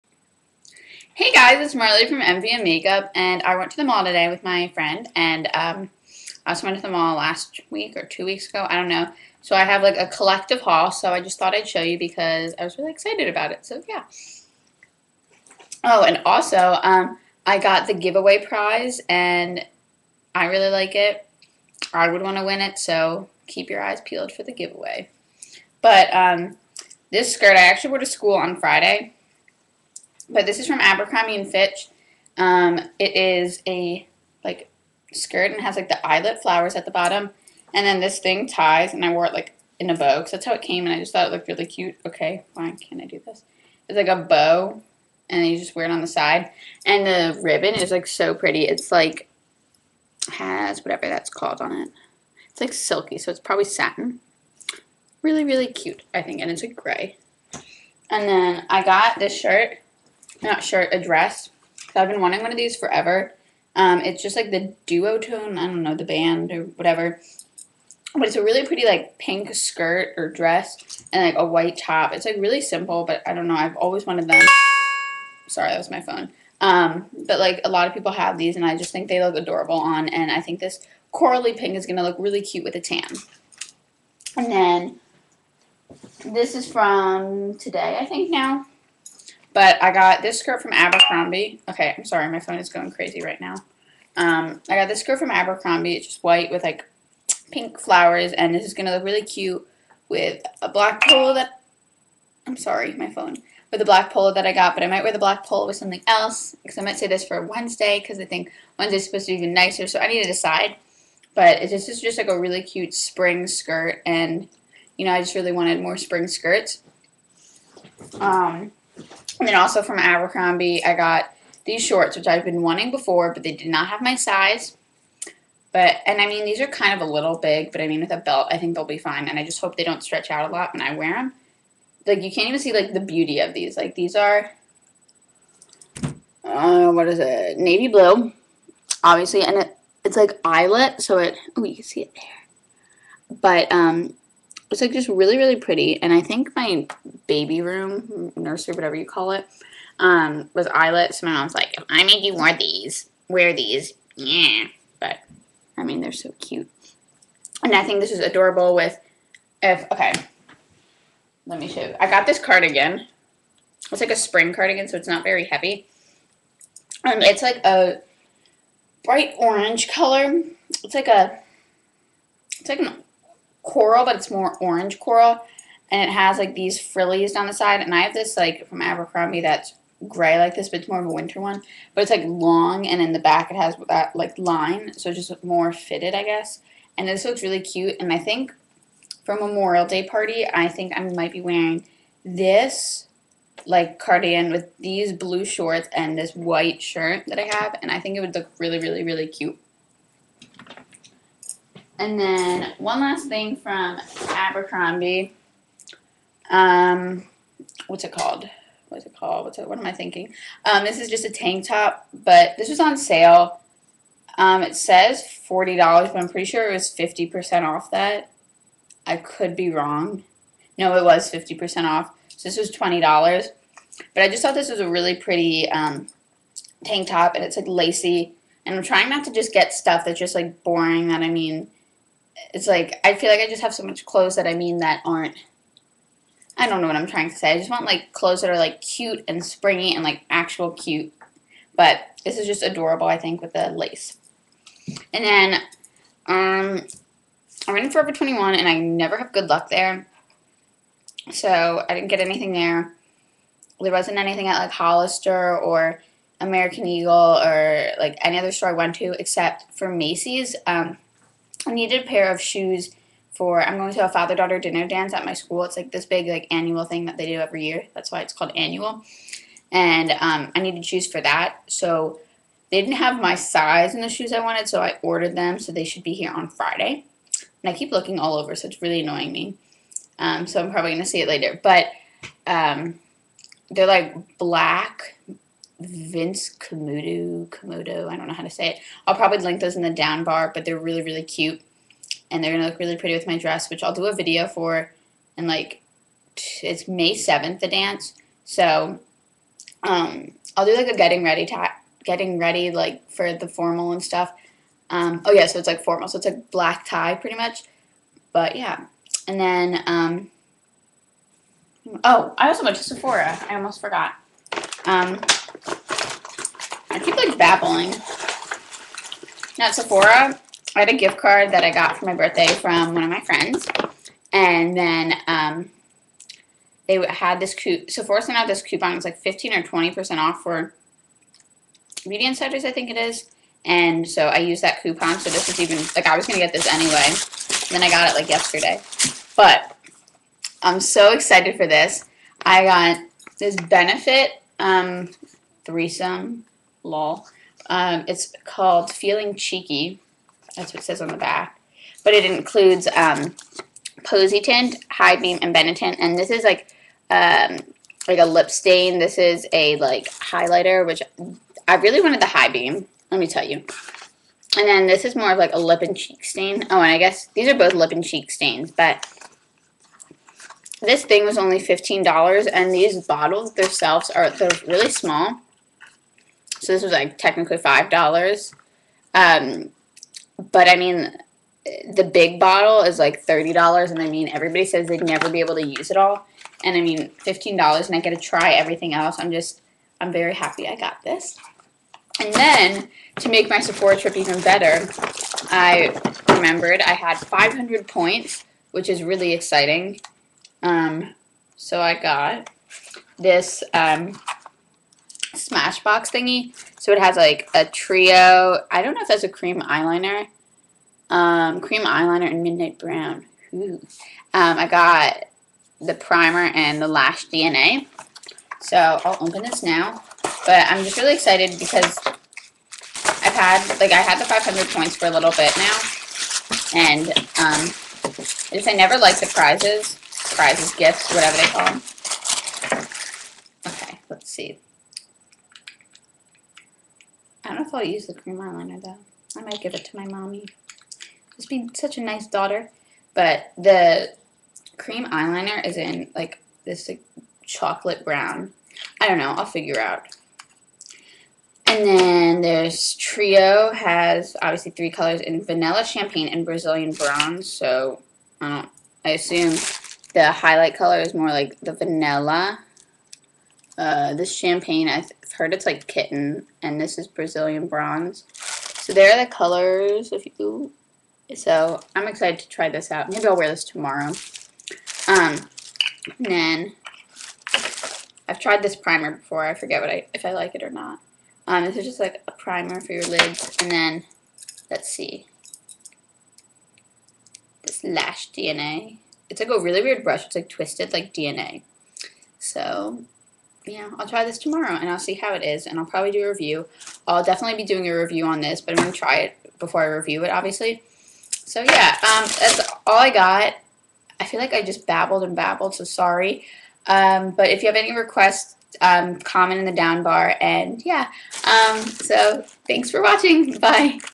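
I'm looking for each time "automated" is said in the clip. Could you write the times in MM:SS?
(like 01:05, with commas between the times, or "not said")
not said.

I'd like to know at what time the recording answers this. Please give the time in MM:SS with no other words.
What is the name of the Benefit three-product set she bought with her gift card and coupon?
05:48.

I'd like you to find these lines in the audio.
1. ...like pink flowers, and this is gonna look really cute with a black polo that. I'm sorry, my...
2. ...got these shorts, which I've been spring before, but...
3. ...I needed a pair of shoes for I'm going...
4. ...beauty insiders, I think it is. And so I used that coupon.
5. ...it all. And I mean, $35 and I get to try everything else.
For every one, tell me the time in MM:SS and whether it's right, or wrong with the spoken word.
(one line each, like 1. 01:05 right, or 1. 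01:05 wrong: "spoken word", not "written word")
1. 01:36 right
2. 02:00 wrong: "wanting", not "spring"
3. 04:21 right
4. 05:32 right
5. 06:25 wrong: "15", not "35".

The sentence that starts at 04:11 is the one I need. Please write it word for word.
So I didn't get anything there.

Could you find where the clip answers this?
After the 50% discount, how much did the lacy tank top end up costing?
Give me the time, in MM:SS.
03:42.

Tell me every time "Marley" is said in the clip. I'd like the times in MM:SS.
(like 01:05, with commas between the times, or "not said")
00:01.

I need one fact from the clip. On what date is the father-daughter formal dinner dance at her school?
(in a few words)
May 7th.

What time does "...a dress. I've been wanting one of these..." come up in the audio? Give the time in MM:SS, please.
01:00.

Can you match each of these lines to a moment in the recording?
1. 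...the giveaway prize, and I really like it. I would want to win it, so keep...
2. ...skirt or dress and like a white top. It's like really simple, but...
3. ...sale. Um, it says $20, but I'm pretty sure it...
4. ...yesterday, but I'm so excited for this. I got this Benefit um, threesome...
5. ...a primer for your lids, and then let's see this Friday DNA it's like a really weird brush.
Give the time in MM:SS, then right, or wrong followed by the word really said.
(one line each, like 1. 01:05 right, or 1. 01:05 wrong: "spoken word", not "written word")
1. 00:17 right
2. 01:09 right
3. 03:32 wrong: "40", not "20"
4. 05:38 right
5. 08:02 wrong: "Lash", not "Friday".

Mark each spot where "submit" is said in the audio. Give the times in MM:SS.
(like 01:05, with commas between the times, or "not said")
not said.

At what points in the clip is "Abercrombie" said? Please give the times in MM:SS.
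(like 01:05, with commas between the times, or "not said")
00:30, 01:30, 01:35, 01:59, 02:58, 03:24.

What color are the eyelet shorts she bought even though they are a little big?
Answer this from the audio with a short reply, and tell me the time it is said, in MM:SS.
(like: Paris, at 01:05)
Navy blue, at 02:17.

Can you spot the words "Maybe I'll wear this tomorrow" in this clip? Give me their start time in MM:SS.
07:53.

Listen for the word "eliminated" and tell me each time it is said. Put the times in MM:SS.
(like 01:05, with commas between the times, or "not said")
not said.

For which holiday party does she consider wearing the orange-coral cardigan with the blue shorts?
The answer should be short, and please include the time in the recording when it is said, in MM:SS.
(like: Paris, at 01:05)
Memorial Day, at 03:09.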